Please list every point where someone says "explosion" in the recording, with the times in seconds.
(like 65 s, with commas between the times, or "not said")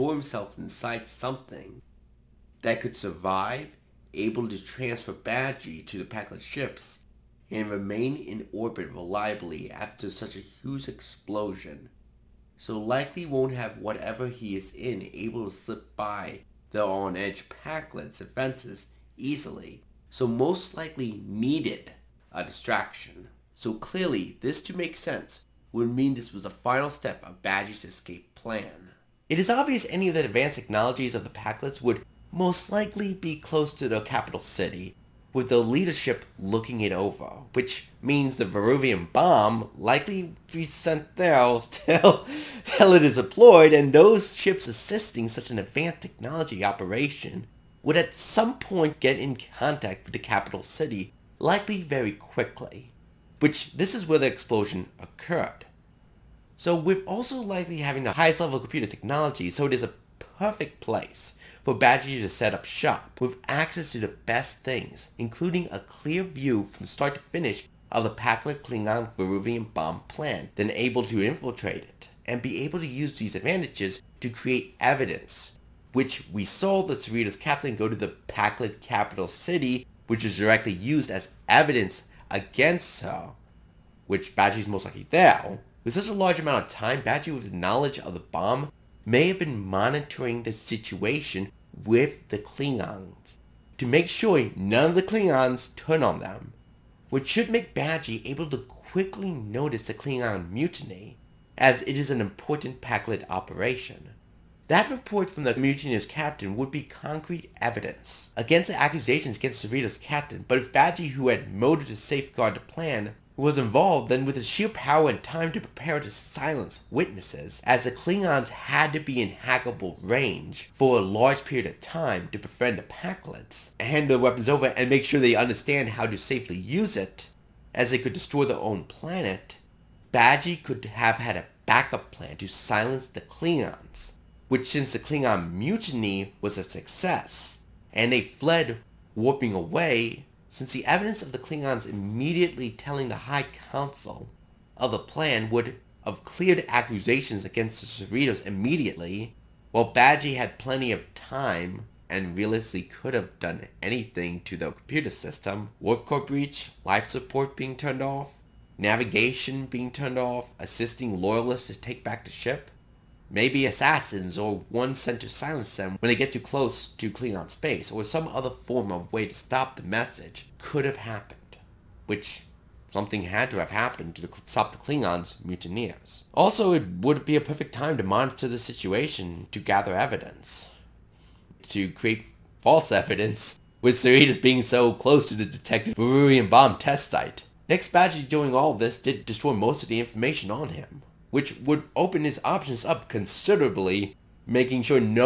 10 s, 54 s.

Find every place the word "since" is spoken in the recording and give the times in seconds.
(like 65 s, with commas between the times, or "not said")
134 s, 140 s.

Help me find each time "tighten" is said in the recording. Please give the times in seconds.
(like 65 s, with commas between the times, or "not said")
not said.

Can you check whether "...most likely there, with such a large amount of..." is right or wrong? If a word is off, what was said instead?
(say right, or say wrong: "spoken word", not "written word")
right.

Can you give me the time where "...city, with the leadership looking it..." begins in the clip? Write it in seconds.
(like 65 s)
34 s.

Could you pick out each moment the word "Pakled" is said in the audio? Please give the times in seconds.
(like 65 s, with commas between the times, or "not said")
6 s, 17 s, 31 s, 68 s, 78 s, 102 s, 122 s.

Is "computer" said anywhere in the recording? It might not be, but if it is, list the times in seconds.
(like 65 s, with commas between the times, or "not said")
58 s, 154 s.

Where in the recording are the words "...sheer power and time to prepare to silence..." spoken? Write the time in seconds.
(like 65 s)
114 s.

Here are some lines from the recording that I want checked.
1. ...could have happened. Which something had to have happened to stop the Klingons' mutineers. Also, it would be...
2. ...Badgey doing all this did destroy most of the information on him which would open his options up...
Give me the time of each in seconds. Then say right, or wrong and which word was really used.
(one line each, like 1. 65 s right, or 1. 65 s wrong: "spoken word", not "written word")
1. 170 s right
2. 187 s right.